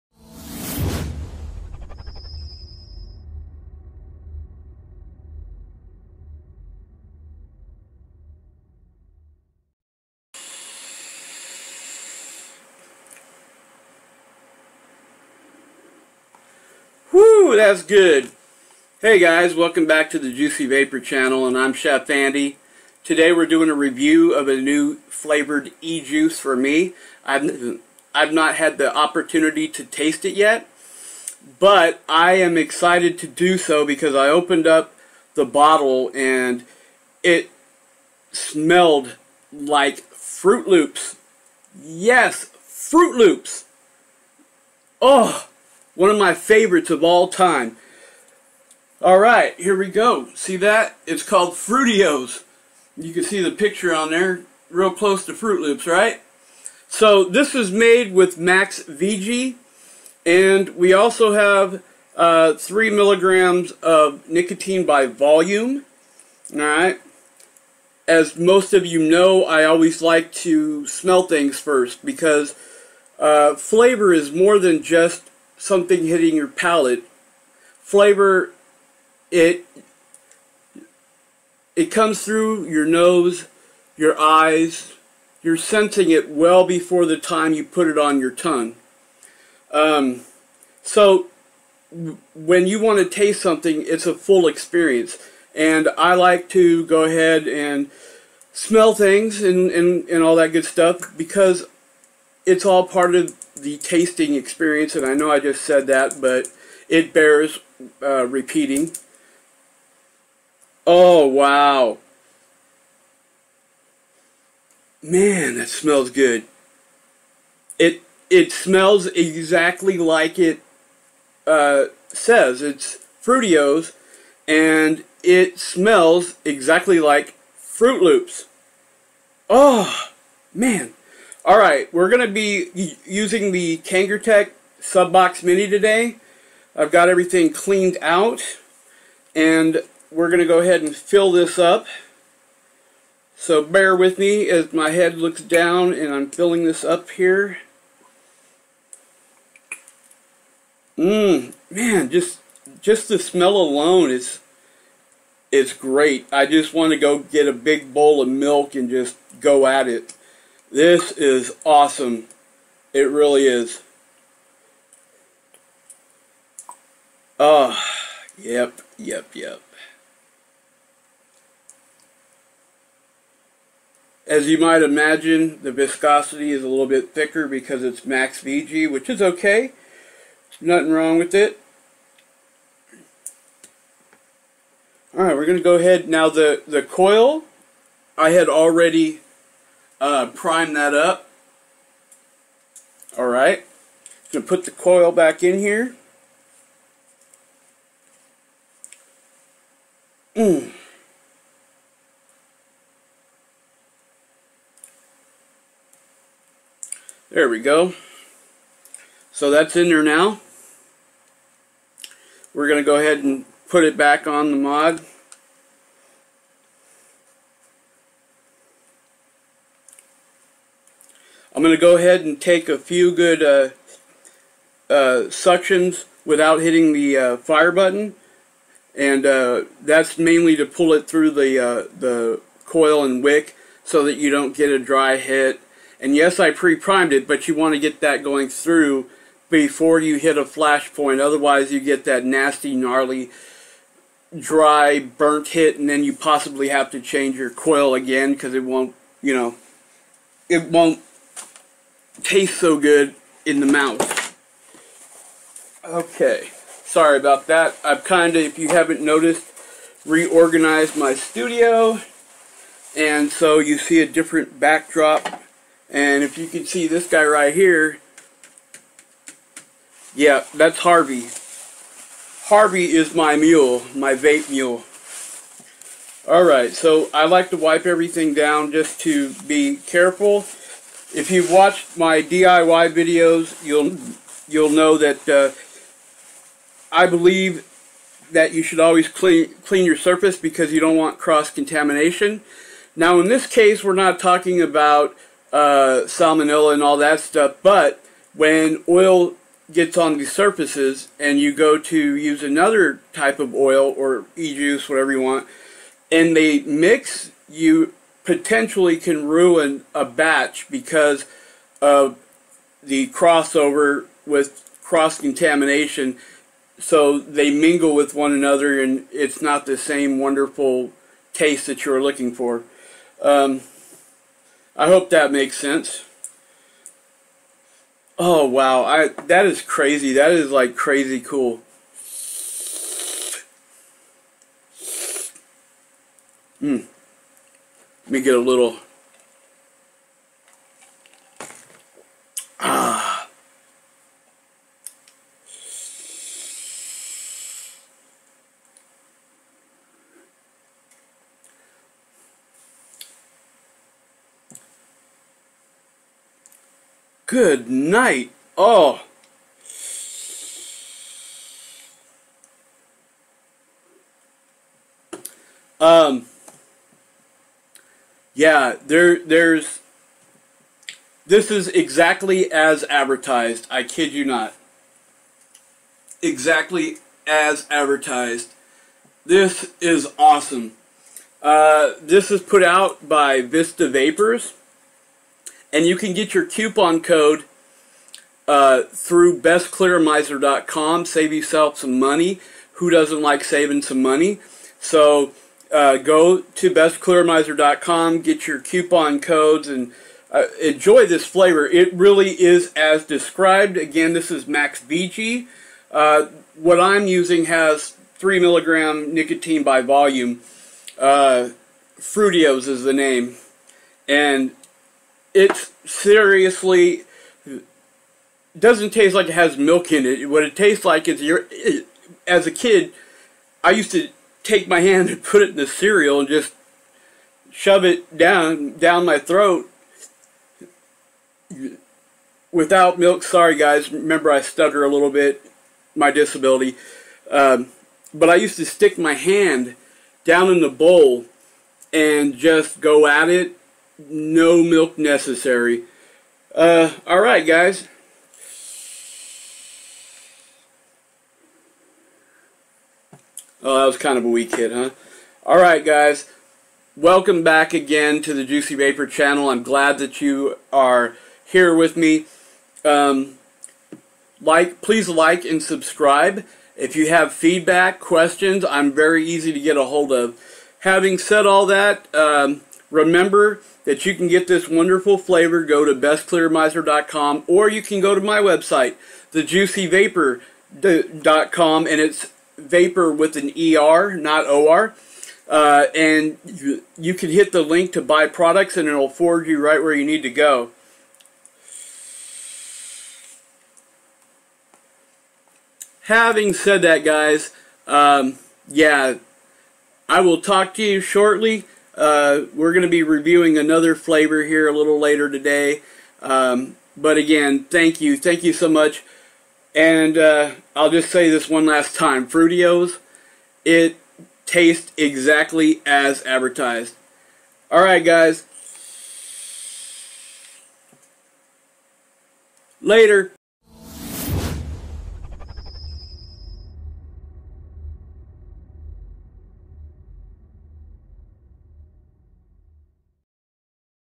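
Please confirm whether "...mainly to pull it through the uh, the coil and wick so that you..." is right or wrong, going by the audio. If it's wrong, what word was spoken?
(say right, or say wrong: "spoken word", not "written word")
right.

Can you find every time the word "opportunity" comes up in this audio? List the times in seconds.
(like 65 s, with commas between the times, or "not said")
28 s.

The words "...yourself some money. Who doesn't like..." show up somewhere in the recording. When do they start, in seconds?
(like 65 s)
391 s.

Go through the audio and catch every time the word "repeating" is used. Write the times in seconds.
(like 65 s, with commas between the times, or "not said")
108 s.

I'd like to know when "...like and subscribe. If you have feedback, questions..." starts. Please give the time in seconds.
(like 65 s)
465 s.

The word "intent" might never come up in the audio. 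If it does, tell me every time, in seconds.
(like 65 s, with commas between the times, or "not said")
not said.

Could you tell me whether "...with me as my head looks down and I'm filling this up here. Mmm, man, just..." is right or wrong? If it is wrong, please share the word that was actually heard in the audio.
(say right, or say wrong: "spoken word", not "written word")
right.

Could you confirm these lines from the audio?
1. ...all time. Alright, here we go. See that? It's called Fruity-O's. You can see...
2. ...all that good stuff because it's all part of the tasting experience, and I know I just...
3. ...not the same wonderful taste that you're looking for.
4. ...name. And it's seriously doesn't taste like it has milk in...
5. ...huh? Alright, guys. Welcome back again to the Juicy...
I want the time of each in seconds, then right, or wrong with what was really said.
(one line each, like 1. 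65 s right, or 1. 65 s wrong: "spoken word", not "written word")
1. 47 s right
2. 100 s right
3. 319 s right
4. 412 s right
5. 454 s right.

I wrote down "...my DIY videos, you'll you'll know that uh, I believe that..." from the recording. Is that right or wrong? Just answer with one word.
right.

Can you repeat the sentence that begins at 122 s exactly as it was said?
It's Fruity-O's, and it smells exactly like Froot Loops.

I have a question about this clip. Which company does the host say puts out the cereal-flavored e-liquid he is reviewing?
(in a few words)
Vista Vapors.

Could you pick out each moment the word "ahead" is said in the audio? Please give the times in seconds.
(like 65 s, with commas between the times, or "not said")
97 s, 140 s, 185 s, 212 s, 221 s.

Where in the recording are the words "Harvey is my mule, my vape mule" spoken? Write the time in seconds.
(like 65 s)
272 s.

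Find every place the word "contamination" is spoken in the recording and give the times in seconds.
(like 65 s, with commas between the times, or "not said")
291 s, 315 s.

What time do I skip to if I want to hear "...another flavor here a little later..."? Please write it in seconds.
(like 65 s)
503 s.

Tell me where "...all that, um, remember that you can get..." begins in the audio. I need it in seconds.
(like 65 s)
471 s.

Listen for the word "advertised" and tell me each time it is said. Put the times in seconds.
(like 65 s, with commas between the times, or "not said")
372 s, 377 s, 516 s.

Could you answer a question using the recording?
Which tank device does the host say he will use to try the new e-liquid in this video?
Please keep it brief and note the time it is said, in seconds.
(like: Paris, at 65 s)
Kangertech Subox Mini, at 133 s.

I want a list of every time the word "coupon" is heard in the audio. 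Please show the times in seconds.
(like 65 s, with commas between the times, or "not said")
386 s, 398 s.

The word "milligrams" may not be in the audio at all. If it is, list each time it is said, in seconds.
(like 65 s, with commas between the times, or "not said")
62 s, 408 s.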